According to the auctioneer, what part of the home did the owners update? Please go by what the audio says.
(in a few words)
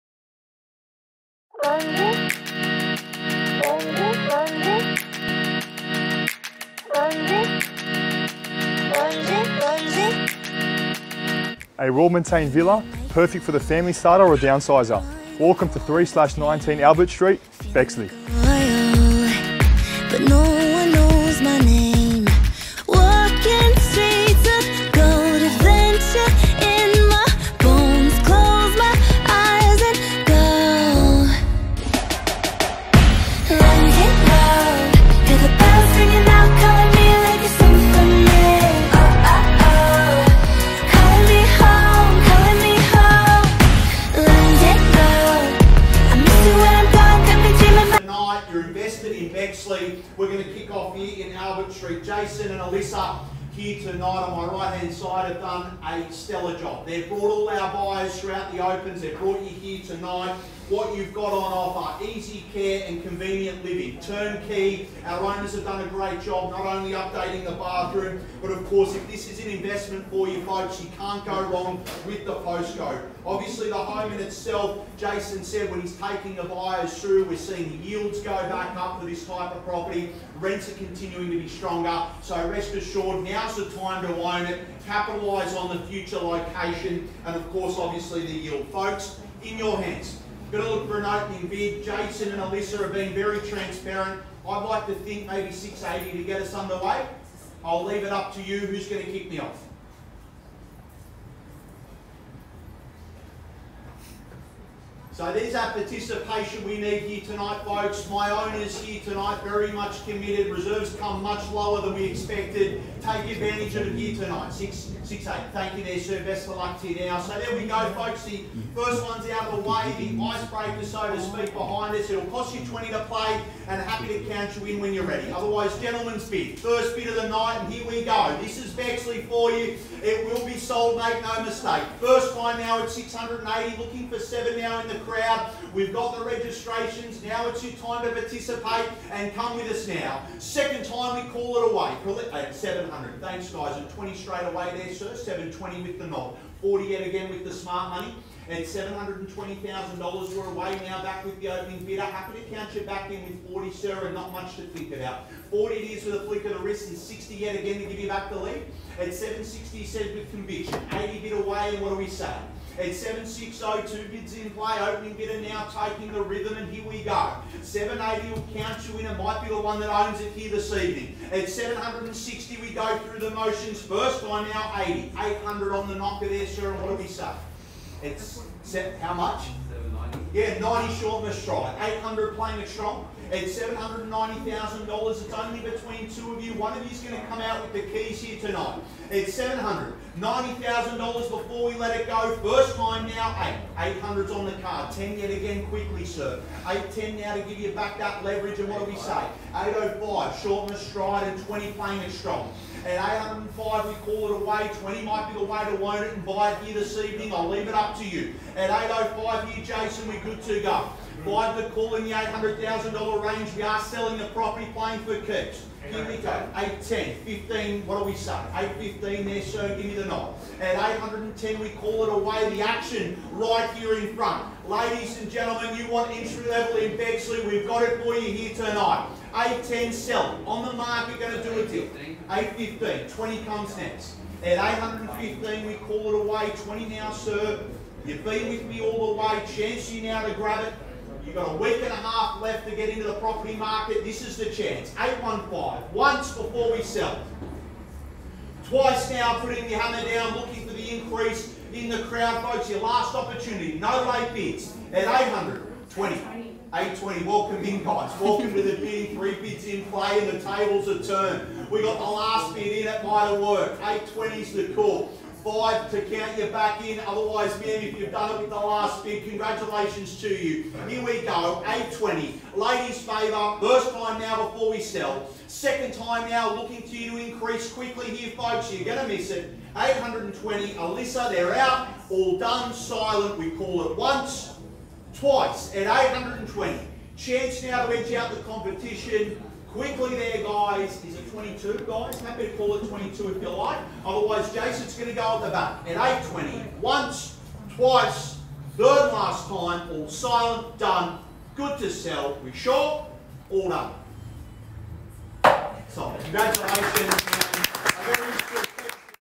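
The bathroom.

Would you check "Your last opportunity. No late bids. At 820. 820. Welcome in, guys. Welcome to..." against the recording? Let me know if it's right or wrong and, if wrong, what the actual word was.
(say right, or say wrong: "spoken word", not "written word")
right.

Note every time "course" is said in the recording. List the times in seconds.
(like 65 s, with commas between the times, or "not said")
68 s, 87 s.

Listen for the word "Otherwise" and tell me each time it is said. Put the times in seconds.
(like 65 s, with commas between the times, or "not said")
125 s, 267 s, 294 s.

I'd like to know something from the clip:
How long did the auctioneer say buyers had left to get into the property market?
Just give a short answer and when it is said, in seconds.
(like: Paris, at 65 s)
A week and a half, at 241 s.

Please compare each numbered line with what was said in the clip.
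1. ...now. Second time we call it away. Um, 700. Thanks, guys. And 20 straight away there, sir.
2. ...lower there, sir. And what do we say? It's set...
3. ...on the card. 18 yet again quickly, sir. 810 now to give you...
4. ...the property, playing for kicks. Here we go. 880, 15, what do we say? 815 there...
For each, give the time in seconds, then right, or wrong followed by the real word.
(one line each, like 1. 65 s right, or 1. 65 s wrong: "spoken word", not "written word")
1. 139 s right
2. 175 s wrong: "knocker", not "lower"
3. 194 s wrong: "10", not "18"
4. 214 s wrong: "810", not "880".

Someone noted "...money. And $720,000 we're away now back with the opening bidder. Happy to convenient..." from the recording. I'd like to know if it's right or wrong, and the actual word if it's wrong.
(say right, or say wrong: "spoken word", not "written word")
wrong: "count", not "convenient".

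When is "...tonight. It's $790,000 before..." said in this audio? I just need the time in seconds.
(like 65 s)
188 s.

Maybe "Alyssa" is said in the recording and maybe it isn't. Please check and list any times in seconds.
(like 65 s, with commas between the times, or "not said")
52 s, 92 s, 280 s.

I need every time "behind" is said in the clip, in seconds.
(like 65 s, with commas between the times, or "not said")
121 s.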